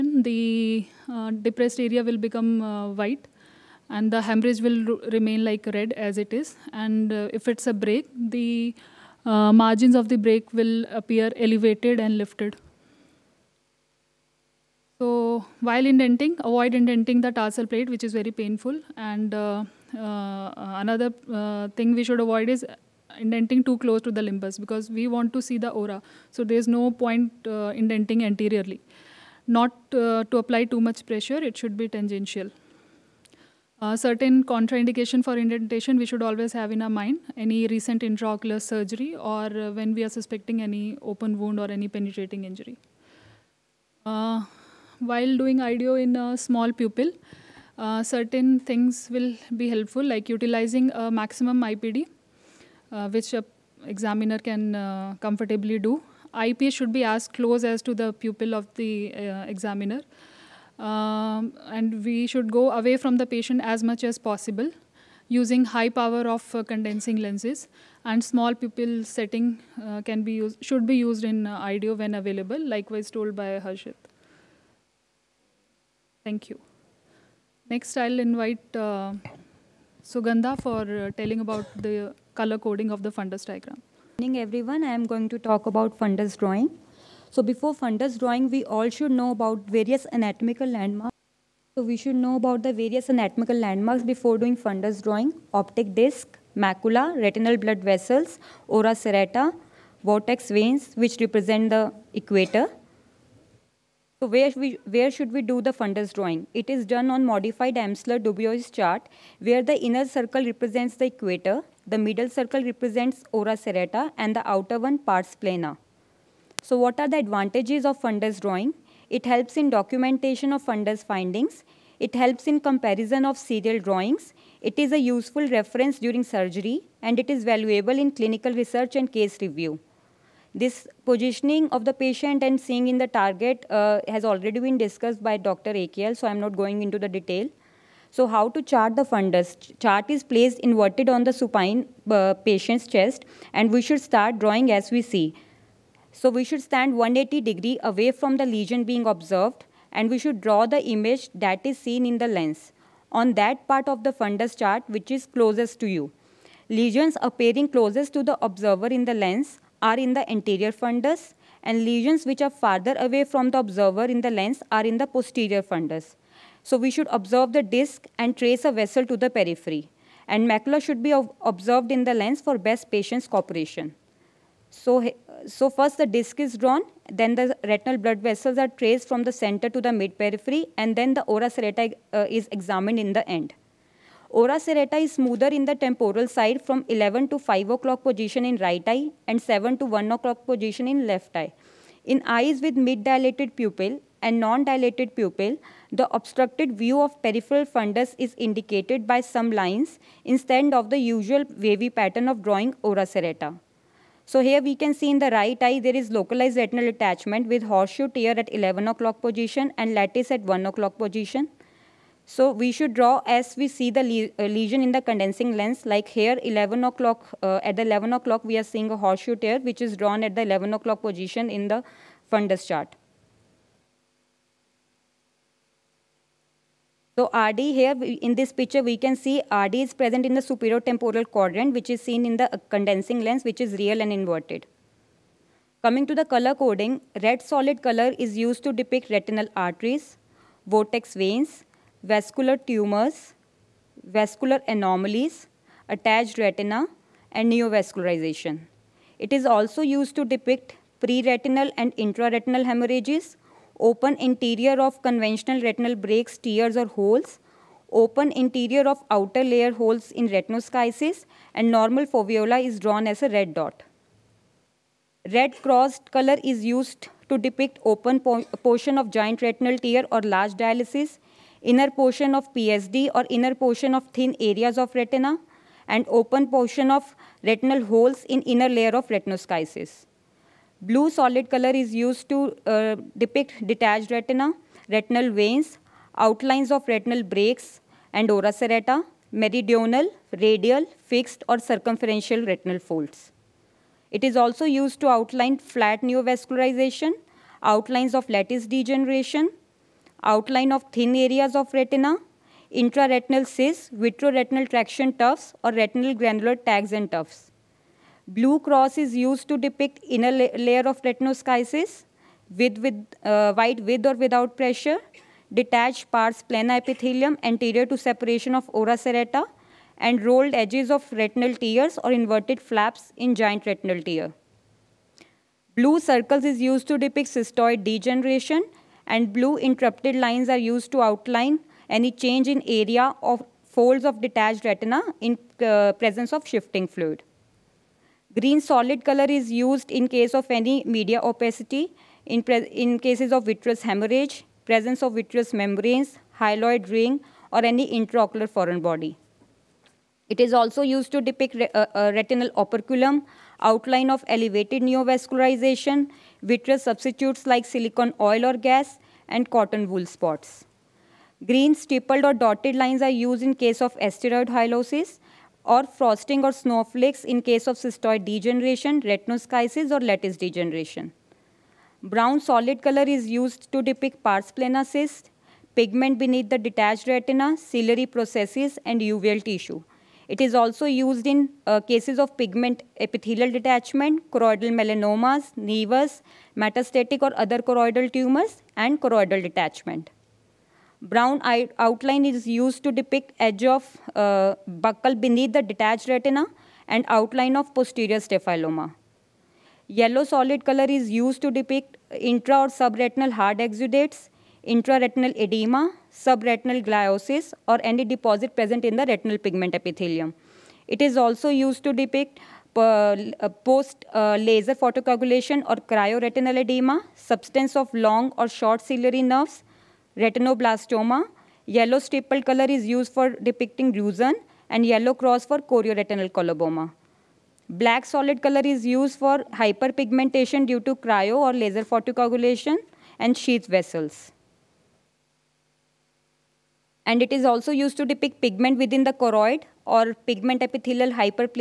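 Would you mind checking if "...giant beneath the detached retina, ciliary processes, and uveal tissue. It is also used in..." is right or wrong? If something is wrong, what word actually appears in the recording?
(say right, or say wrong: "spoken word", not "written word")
wrong: "pigment", not "giant".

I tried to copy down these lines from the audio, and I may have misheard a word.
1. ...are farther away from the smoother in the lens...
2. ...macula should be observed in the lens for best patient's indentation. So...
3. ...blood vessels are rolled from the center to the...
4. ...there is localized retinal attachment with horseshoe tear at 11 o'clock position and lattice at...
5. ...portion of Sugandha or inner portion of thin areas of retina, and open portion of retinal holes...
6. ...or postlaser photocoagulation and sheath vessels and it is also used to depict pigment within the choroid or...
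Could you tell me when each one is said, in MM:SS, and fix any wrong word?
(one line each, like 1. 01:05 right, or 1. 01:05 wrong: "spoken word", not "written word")
1. 02:42 wrong: "observer", not "smoother"
2. 02:50 wrong: "cooperation", not "indentation"
3. 02:57 wrong: "traced", not "rolled"
4. 03:25 right
5. 04:31 wrong: "PSD", not "Sugandha"
6. 07:11 wrong: "laser", not "postlaser".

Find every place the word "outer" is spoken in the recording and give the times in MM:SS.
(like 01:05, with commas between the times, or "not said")
01:54, 04:19.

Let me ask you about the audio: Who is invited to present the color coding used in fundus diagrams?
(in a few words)
Sugandha.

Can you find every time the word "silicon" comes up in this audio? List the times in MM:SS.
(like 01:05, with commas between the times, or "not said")
05:57.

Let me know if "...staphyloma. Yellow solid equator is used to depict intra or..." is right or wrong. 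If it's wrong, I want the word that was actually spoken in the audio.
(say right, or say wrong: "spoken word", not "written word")
wrong: "color", not "equator".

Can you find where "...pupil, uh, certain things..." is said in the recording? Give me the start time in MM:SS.
00:46.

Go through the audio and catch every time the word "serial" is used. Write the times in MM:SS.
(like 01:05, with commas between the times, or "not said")
02:03.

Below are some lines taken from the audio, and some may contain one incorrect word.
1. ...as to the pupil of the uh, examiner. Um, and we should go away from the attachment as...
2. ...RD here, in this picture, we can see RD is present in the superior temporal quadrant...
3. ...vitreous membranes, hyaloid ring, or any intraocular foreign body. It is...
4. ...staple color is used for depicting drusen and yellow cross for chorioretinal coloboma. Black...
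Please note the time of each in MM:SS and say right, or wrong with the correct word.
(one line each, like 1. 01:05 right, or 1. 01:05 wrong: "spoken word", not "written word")
1. 00:57 wrong: "patient", not "attachment"
2. 03:47 right
3. 05:45 right
4. 07:01 right.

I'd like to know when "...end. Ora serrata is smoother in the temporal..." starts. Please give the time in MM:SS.
03:03.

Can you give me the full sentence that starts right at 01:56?
So what are the advantages of fundus drawing?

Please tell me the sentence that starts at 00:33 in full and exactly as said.
Uh, certain contraindication for indentation we should always have in our mind.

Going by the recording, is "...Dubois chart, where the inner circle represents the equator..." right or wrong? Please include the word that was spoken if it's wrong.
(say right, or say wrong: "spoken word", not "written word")
right.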